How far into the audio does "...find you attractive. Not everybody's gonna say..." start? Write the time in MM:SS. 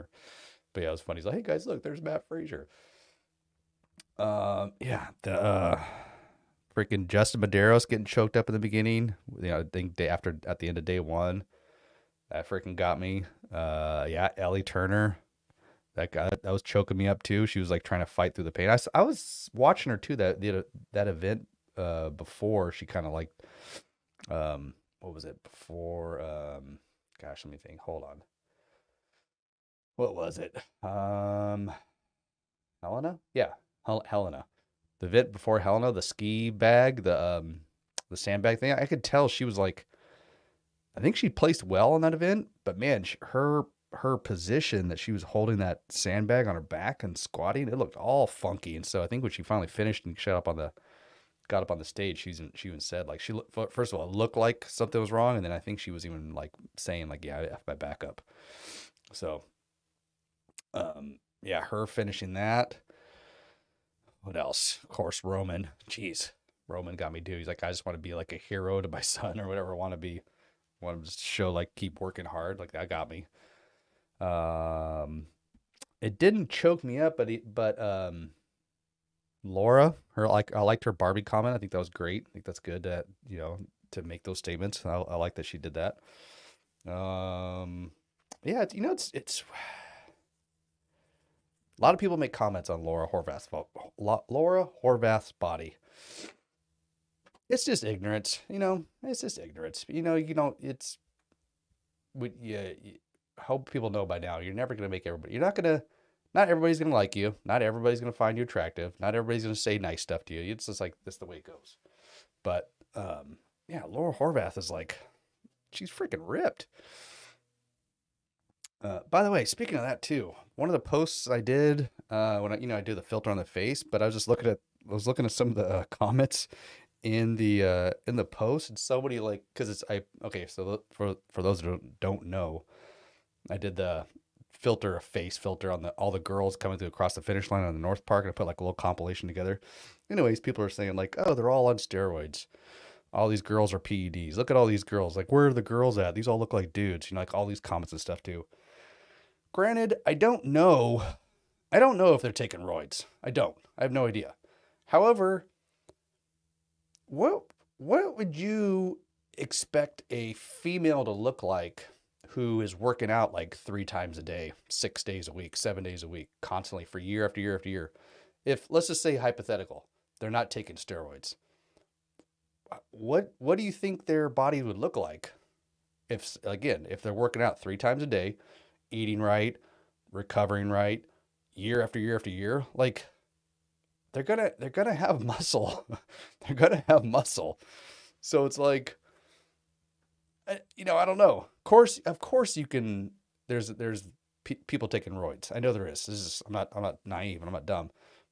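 01:48.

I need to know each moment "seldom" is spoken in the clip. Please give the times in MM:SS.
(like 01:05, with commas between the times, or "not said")
not said.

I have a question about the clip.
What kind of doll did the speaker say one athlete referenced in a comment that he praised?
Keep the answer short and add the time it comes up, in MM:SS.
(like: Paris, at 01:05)
Barbie, at 01:20.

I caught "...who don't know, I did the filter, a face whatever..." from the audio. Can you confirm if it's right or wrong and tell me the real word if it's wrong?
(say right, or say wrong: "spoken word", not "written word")
wrong: "filter", not "whatever".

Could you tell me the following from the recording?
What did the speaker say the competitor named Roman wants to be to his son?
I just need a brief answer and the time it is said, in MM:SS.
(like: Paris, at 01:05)
A hero, at 01:08.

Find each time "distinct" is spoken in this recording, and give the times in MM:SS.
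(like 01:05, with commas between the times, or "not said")
not said.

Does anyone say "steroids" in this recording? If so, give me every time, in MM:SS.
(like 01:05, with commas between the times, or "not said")
02:21, 02:50.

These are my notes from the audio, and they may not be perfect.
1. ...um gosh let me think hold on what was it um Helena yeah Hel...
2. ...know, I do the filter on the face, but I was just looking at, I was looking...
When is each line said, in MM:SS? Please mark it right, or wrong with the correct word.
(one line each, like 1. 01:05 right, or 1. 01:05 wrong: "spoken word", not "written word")
1. 00:26 right
2. 02:02 right.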